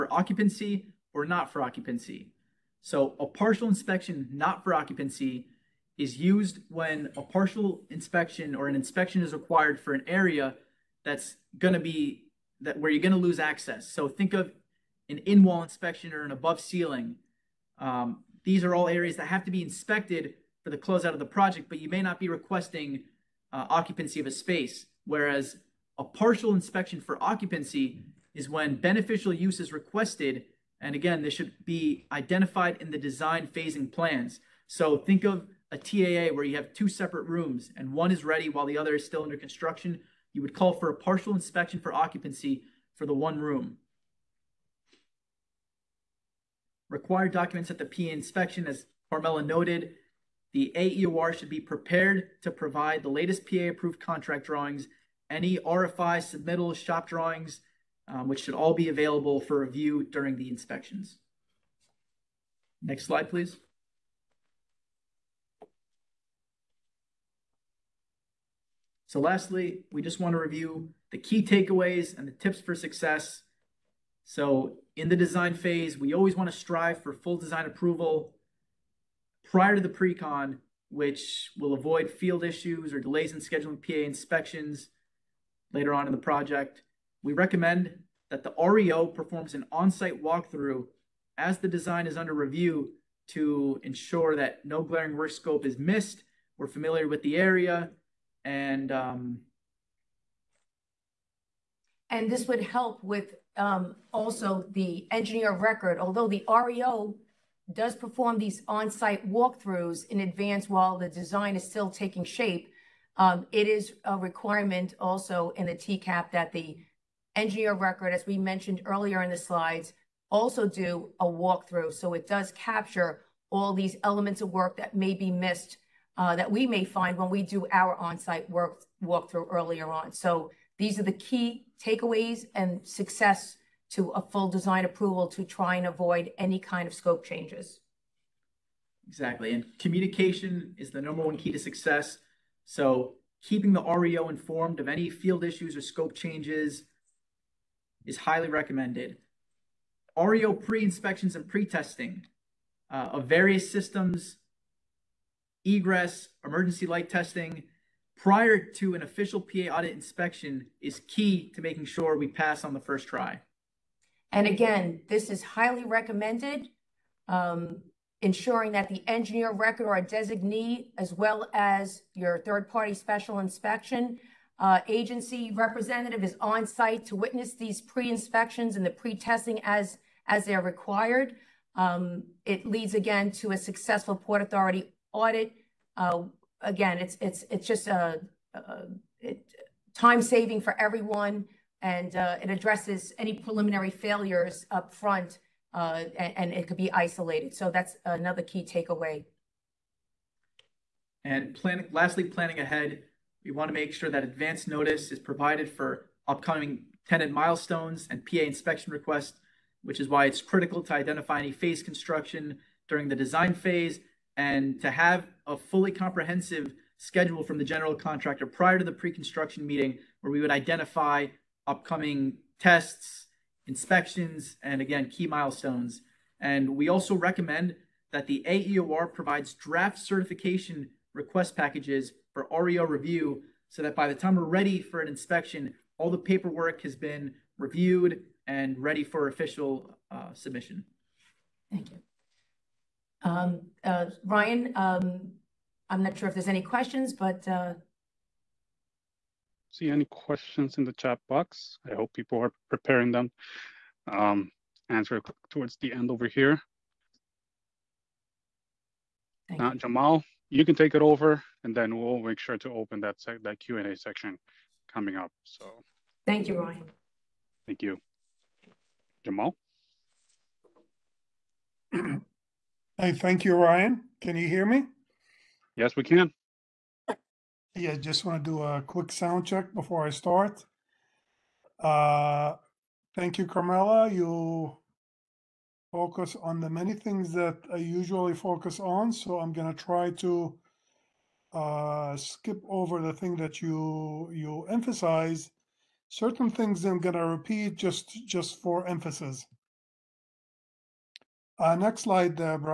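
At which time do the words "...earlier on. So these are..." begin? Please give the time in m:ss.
2:09.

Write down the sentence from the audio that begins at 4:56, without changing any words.
Certain things I'm going to repeat just just for emphasis.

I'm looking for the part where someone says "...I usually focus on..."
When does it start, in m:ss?
4:47.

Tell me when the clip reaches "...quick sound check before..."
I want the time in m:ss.
4:38.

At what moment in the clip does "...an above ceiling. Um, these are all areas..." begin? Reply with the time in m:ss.
0:16.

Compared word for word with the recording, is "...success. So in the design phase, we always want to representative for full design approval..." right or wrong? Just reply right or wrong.
wrong.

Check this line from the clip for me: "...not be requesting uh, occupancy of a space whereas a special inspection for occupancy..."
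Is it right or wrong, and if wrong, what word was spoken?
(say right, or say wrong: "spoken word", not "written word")
wrong: "partial", not "special".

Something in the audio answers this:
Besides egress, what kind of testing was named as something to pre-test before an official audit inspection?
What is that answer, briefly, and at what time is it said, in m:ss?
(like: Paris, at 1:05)
Emergency light testing, at 2:36.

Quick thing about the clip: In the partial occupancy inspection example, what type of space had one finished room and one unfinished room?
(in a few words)
TAA.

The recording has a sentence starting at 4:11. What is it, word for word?
I hope people are preparing them.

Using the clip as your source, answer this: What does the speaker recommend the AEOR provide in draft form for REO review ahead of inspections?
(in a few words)
Certification request packages.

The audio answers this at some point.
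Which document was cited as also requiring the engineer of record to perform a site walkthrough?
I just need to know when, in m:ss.
1:55.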